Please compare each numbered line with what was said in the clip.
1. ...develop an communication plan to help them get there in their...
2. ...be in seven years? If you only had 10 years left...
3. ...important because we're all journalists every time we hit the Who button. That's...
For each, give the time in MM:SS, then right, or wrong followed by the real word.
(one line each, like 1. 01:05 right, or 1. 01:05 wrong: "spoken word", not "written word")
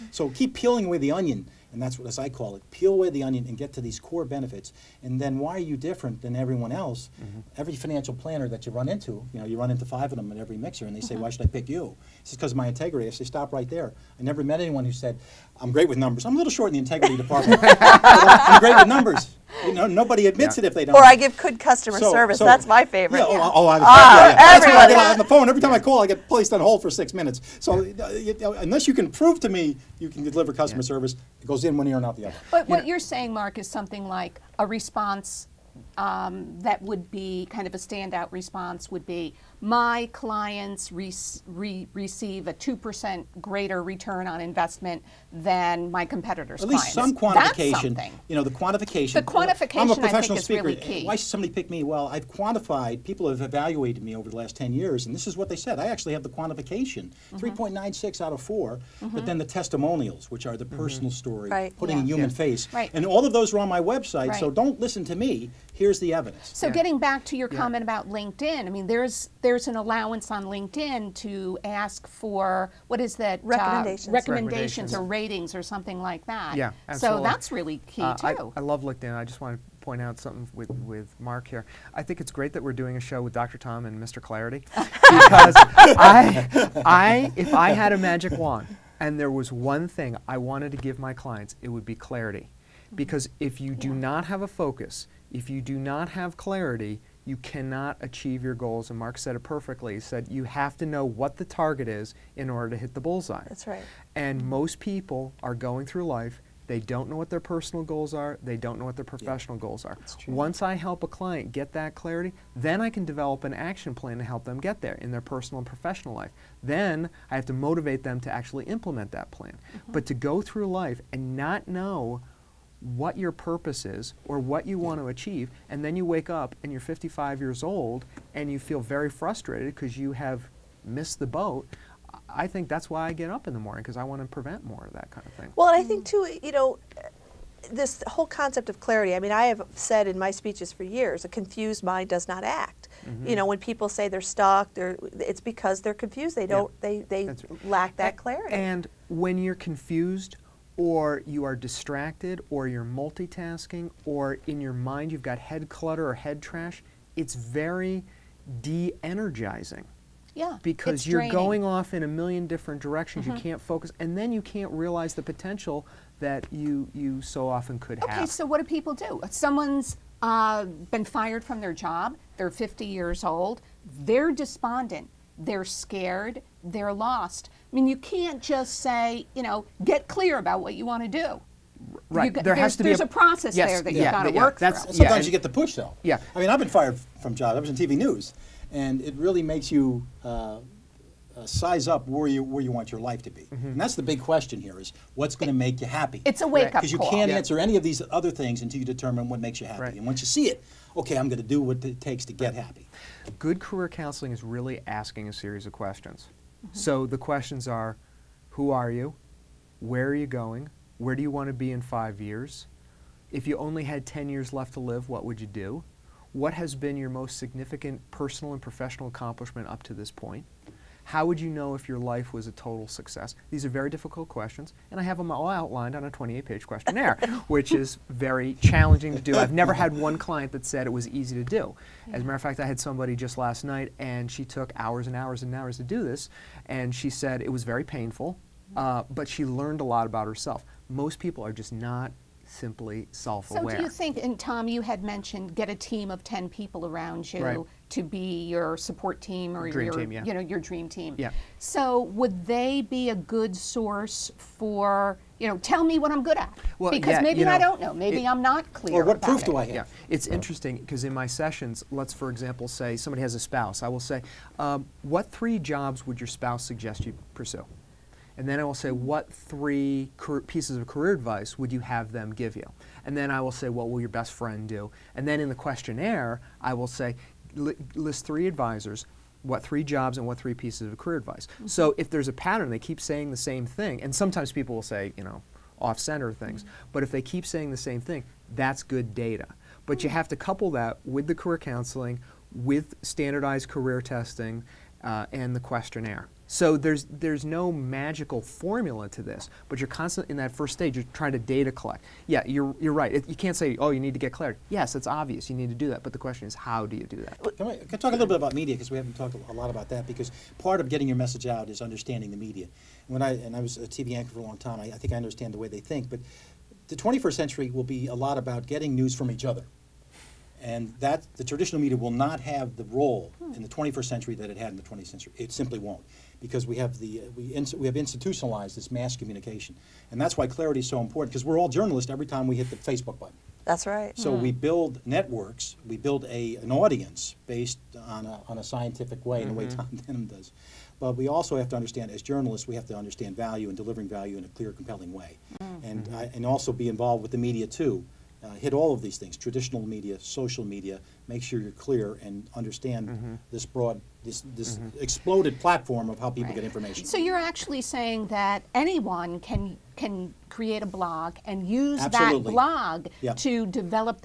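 1. 01:53 wrong: "action", not "communication"
2. 03:31 wrong: "five", not "seven"
3. 05:30 wrong: "Facebook", not "Who".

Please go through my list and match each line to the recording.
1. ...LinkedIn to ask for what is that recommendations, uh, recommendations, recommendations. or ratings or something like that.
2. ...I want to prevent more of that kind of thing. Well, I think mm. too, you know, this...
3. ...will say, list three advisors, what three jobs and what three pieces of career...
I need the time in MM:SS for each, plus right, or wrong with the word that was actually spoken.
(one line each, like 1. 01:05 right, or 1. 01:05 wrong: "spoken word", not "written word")
1. 01:10 right
2. 02:13 right
3. 04:36 right.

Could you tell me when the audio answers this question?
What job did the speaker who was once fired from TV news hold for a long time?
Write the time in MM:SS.
05:13.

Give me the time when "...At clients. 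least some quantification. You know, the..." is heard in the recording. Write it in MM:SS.
00:46.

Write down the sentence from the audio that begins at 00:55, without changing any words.
I actually have the quantification mm -hmm.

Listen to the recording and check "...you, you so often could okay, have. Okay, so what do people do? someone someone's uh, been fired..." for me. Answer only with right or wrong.
right.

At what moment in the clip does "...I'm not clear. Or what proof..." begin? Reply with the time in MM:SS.
04:18.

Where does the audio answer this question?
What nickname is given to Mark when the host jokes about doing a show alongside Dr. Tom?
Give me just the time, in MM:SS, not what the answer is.
01:24.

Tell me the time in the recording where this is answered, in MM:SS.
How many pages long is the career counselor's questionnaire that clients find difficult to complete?
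03:46.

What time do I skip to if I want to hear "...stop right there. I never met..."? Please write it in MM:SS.
00:13.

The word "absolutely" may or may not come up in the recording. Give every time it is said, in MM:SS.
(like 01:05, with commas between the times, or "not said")
01:16, 06:02.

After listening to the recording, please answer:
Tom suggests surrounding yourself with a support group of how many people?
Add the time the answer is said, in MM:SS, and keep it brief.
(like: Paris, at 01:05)
10, at 04:06.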